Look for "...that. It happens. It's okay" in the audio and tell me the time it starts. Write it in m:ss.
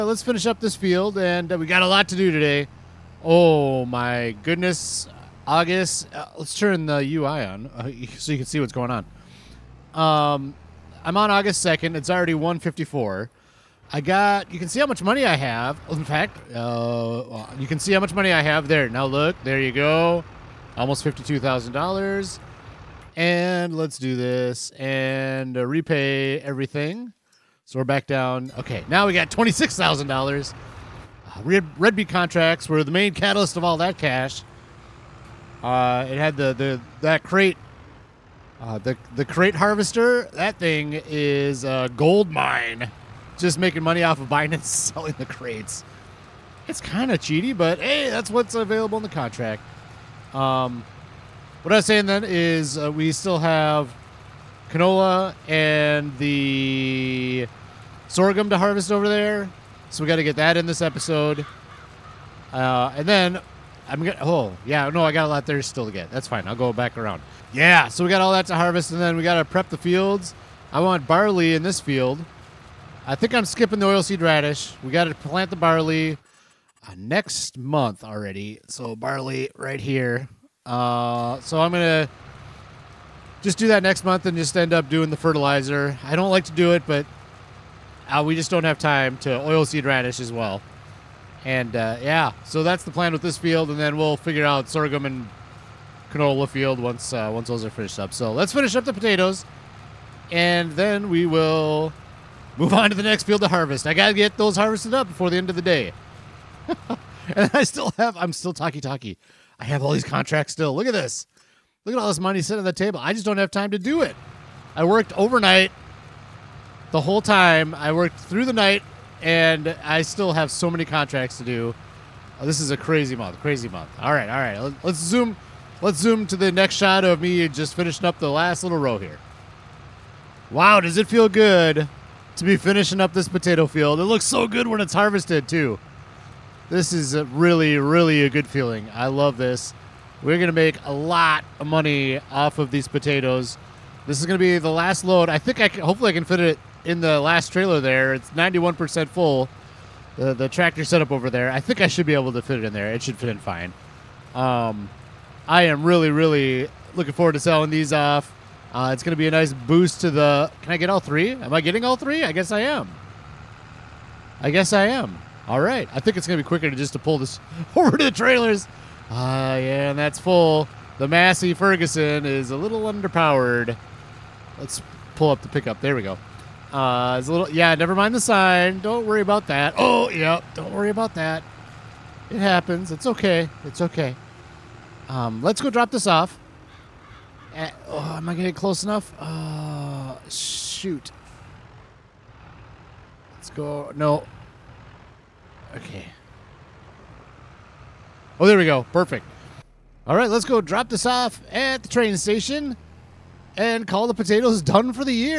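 3:01.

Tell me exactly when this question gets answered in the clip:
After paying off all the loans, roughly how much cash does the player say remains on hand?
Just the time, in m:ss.
0:29.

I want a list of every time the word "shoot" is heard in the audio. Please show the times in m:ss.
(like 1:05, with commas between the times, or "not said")
3:10.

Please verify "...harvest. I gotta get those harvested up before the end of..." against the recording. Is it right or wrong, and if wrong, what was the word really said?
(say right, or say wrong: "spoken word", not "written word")
right.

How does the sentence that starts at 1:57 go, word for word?
I worked through the night and I still have so many contracts to do.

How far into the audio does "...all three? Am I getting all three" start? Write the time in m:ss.
2:40.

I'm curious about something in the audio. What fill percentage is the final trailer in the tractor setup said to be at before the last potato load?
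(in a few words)
91%.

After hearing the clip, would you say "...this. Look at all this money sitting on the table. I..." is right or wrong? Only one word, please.
right.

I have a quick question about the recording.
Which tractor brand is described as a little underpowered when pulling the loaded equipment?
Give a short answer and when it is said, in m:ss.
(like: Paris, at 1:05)
Massey Ferguson, at 2:51.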